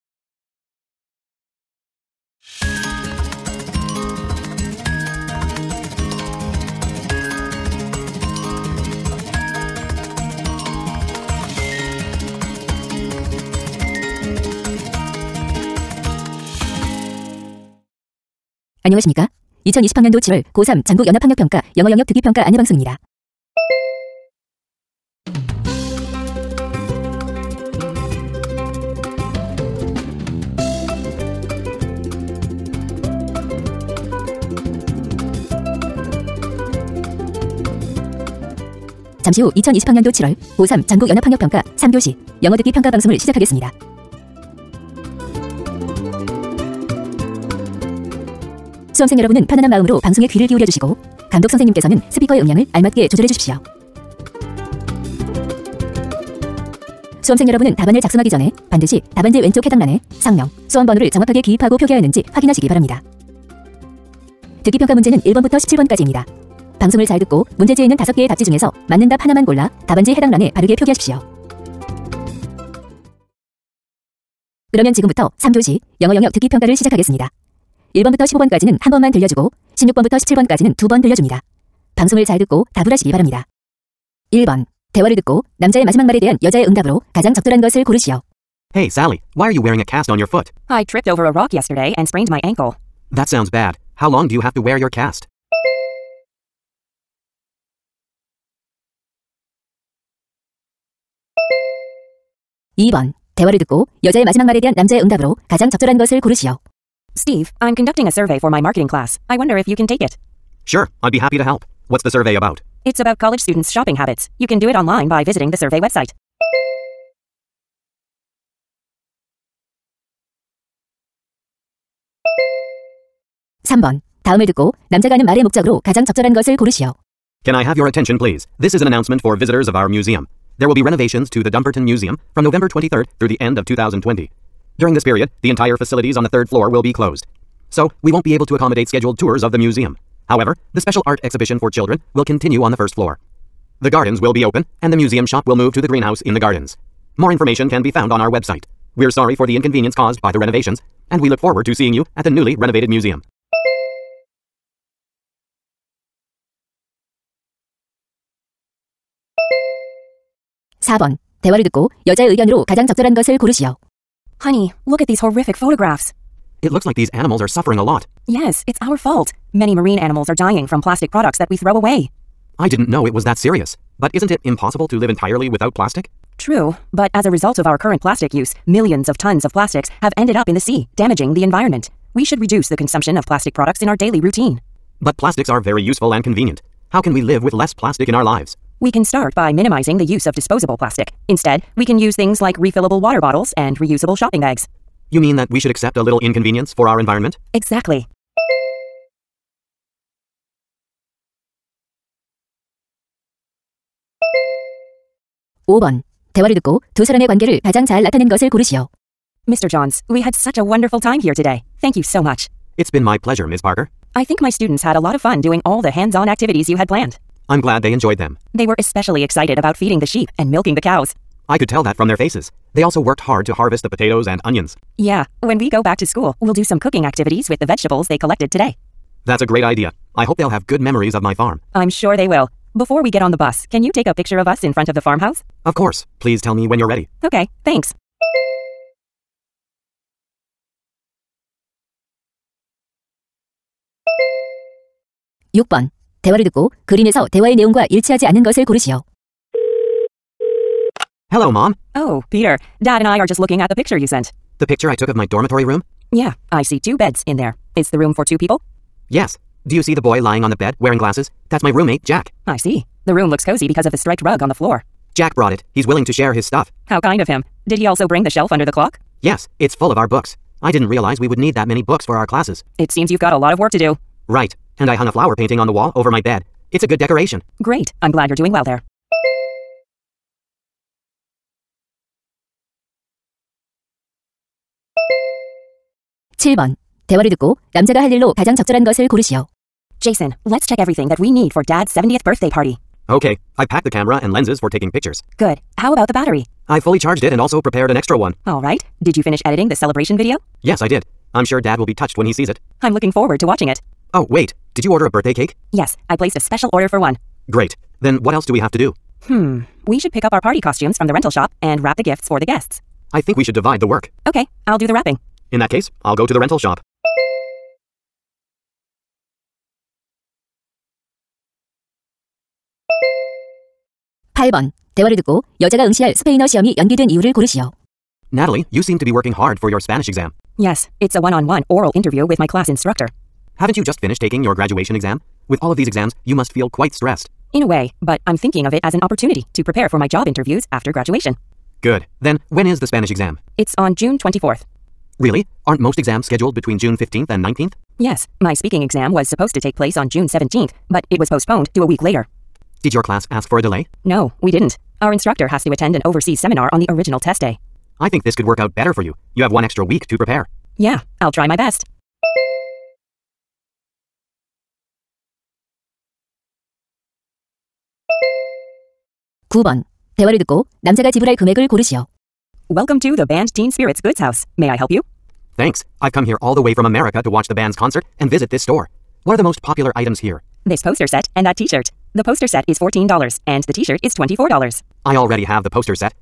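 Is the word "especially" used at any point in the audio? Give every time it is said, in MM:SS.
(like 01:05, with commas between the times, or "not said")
03:38.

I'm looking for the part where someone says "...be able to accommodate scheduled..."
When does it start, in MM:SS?
02:18.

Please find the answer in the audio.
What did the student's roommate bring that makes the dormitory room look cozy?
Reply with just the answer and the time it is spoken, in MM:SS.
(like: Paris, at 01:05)
Striped rug, at 04:23.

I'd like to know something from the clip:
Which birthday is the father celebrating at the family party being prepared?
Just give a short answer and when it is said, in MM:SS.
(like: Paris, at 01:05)
70th, at 04:51.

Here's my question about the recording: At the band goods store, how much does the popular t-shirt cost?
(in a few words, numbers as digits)
$24.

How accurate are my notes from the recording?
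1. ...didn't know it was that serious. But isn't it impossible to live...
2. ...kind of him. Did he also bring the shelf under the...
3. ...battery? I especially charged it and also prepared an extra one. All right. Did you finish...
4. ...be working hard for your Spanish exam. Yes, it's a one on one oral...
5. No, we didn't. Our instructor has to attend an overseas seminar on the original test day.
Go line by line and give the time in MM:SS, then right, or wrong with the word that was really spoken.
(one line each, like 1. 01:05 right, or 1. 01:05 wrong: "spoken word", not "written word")
1. 02:52 right
2. 04:26 right
3. 04:56 wrong: "fully", not "especially"
4. 05:29 right
5. 05:54 right.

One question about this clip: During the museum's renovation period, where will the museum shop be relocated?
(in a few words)
The greenhouse in the gardens.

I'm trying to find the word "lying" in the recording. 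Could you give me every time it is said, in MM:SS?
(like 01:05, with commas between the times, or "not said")
04:20.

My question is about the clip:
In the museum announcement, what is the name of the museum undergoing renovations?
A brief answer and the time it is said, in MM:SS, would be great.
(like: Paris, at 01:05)
Dumbarton Museum, at 02:11.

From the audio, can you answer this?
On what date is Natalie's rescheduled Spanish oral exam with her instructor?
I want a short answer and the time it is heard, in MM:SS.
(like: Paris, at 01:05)
June 24th, at 05:43.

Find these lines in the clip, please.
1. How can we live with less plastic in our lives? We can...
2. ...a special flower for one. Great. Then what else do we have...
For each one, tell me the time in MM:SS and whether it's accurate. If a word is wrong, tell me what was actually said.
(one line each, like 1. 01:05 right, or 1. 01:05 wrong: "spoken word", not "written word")
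1. 03:06 right
2. 05:06 wrong: "order", not "flower".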